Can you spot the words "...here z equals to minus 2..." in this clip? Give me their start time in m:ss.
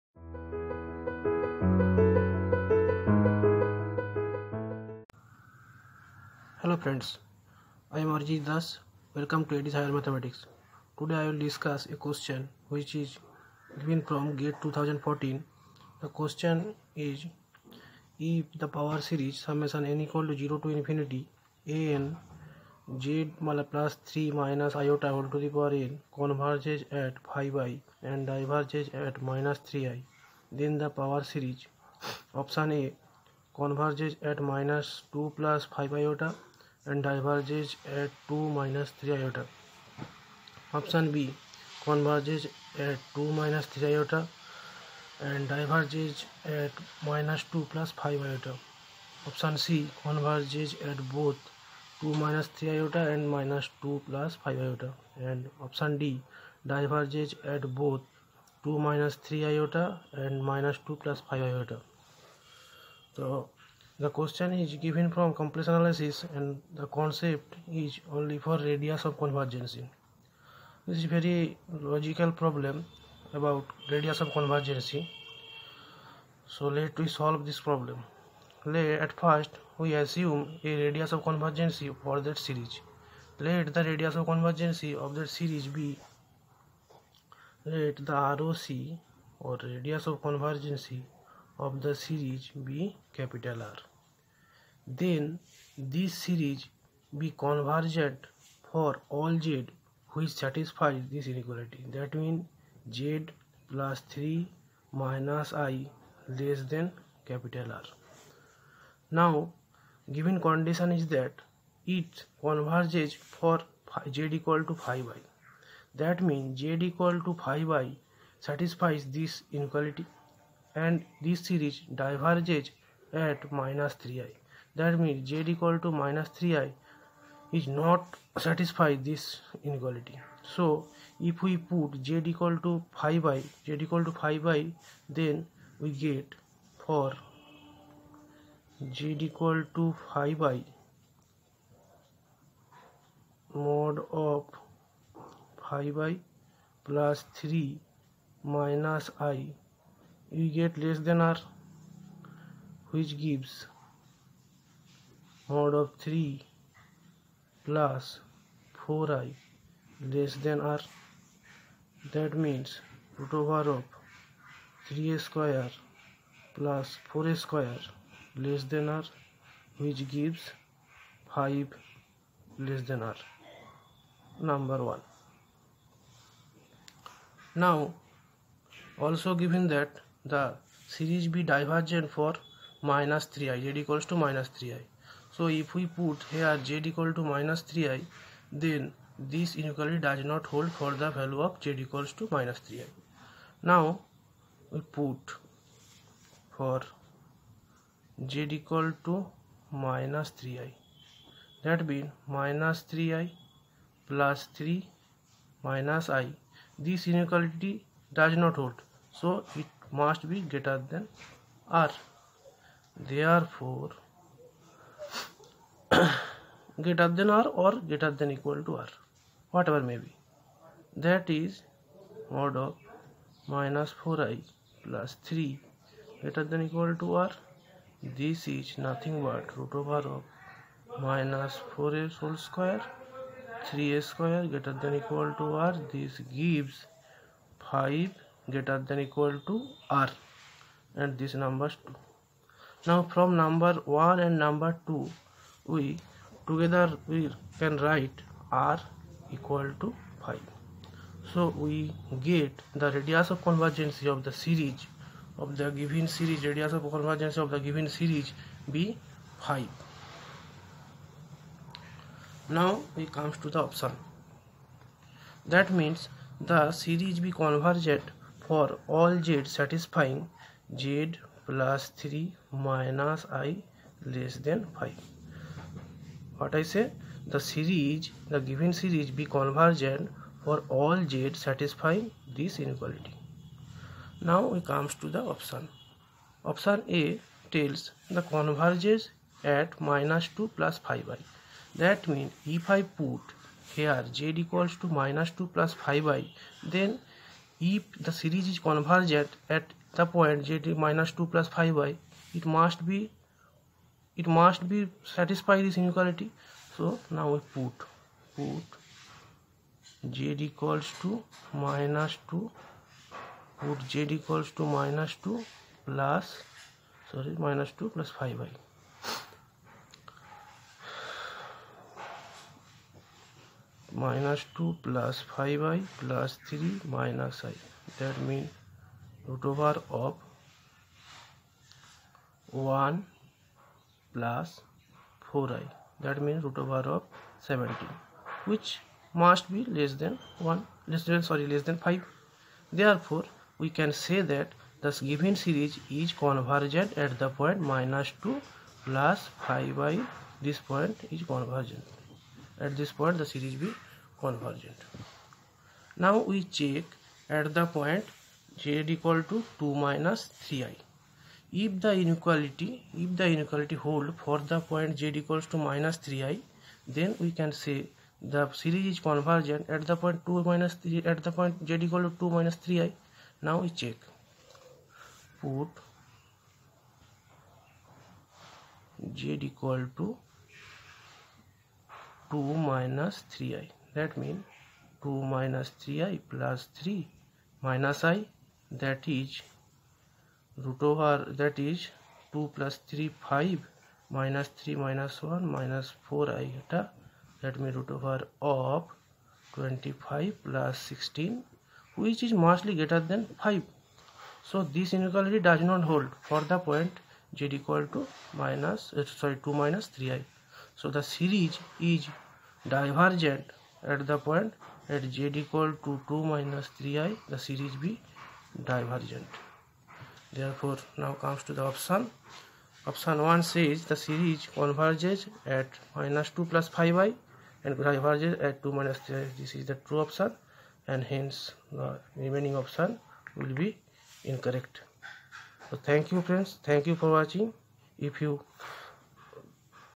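4:53.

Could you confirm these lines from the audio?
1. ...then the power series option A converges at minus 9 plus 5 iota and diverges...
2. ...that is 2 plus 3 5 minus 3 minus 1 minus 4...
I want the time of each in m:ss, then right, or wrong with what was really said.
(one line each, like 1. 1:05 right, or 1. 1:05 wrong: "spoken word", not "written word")
1. 0:30 wrong: "2", not "9"
2. 6:31 right.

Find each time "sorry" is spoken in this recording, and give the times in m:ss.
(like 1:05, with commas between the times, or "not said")
5:17, 5:41, 6:49.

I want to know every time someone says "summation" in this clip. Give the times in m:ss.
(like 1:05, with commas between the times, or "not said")
0:19.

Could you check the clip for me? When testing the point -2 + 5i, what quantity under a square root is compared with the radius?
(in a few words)
17.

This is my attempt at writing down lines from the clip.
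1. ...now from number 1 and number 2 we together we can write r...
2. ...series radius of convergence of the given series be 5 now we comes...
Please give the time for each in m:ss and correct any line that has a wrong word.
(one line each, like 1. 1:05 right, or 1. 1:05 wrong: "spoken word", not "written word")
1. 4:02 right
2. 4:16 right.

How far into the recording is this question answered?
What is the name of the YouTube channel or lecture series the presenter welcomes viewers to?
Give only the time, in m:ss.
0:09.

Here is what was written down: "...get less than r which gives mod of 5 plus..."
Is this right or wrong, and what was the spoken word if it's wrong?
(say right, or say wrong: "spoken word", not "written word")
wrong: "3", not "5".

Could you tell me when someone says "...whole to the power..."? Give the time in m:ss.
0:25.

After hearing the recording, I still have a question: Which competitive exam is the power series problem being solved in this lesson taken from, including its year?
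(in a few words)
GATE 2014.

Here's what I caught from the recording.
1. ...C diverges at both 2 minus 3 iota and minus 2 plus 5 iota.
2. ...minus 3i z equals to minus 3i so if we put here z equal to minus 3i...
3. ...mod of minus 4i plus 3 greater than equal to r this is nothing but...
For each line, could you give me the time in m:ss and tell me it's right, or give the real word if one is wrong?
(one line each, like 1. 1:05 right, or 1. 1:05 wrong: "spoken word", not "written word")
1. 0:49 wrong: "converges", not "diverges"
2. 3:02 right
3. 3:42 right.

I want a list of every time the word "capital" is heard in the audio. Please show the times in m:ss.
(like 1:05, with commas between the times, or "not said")
1:33, 1:47.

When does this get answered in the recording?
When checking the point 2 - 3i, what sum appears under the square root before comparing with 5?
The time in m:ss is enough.
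6:39.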